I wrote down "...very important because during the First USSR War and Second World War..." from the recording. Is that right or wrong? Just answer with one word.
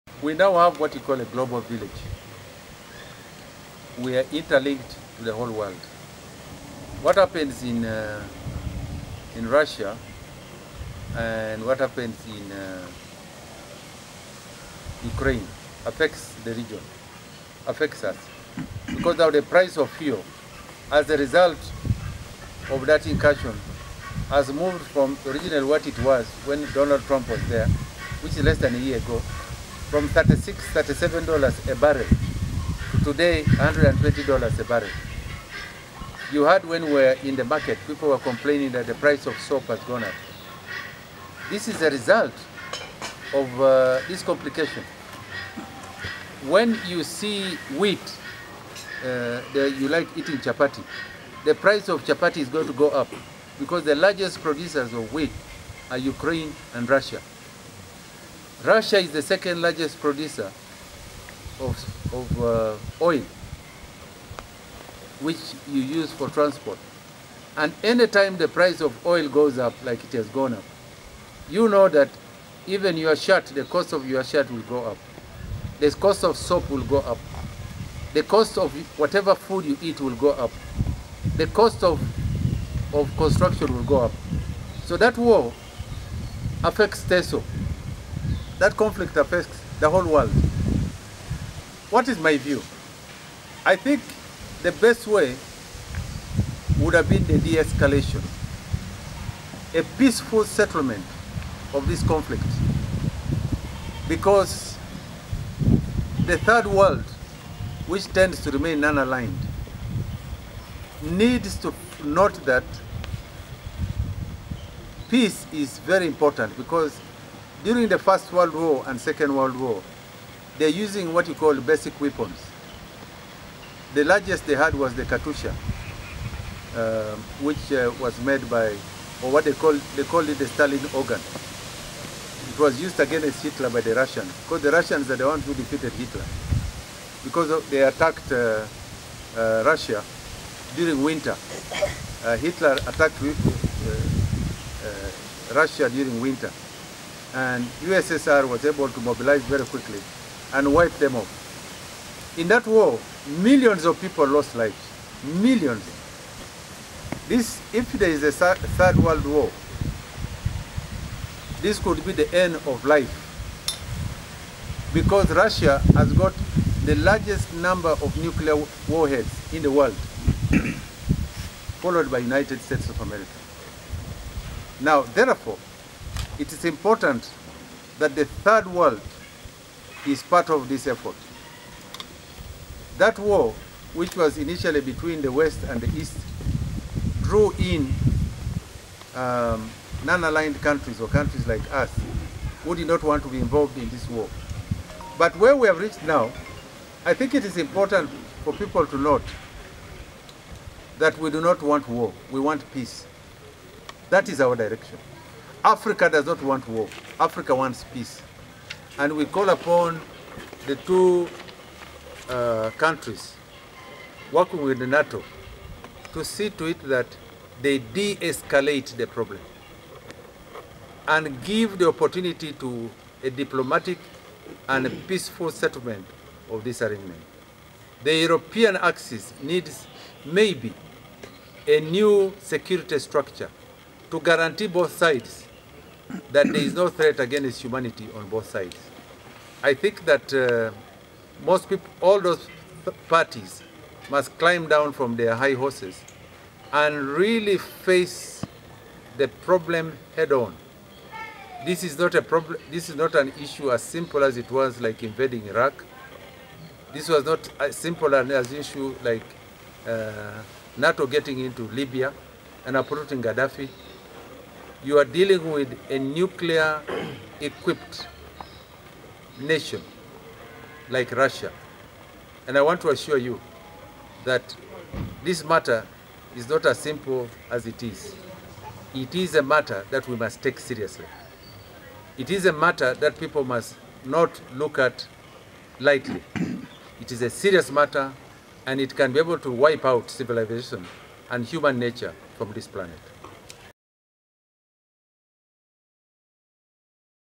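wrong.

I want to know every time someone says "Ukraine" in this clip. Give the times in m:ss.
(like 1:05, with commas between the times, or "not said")
0:15, 0:55.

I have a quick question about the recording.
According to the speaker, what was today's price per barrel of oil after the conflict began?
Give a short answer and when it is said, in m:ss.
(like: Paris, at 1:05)
$120, at 0:33.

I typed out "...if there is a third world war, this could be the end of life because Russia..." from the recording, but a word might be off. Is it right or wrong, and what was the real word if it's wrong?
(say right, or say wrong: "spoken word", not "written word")
right.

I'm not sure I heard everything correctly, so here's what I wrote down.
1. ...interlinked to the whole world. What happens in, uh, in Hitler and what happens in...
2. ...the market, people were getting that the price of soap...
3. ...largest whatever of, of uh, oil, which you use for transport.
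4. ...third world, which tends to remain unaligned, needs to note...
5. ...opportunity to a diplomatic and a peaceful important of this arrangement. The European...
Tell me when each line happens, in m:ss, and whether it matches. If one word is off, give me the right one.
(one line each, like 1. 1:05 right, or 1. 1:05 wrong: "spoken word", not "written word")
1. 0:04 wrong: "Russia", not "Hitler"
2. 0:37 wrong: "complaining", not "getting"
3. 0:59 wrong: "producer", not "whatever"
4. 1:46 right
5. 3:41 wrong: "settlement", not "important".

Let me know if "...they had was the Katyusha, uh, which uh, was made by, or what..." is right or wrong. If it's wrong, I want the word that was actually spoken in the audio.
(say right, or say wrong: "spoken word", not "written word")
right.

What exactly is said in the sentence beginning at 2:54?
Now, therefore, it is important that the third world is part of this effort.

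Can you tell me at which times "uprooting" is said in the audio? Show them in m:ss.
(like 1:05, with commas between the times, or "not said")
4:22.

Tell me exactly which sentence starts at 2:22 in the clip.
Uh, Hitler attacked uh, Russia during winter and USSR was able to mobilize very quickly and wipe them off.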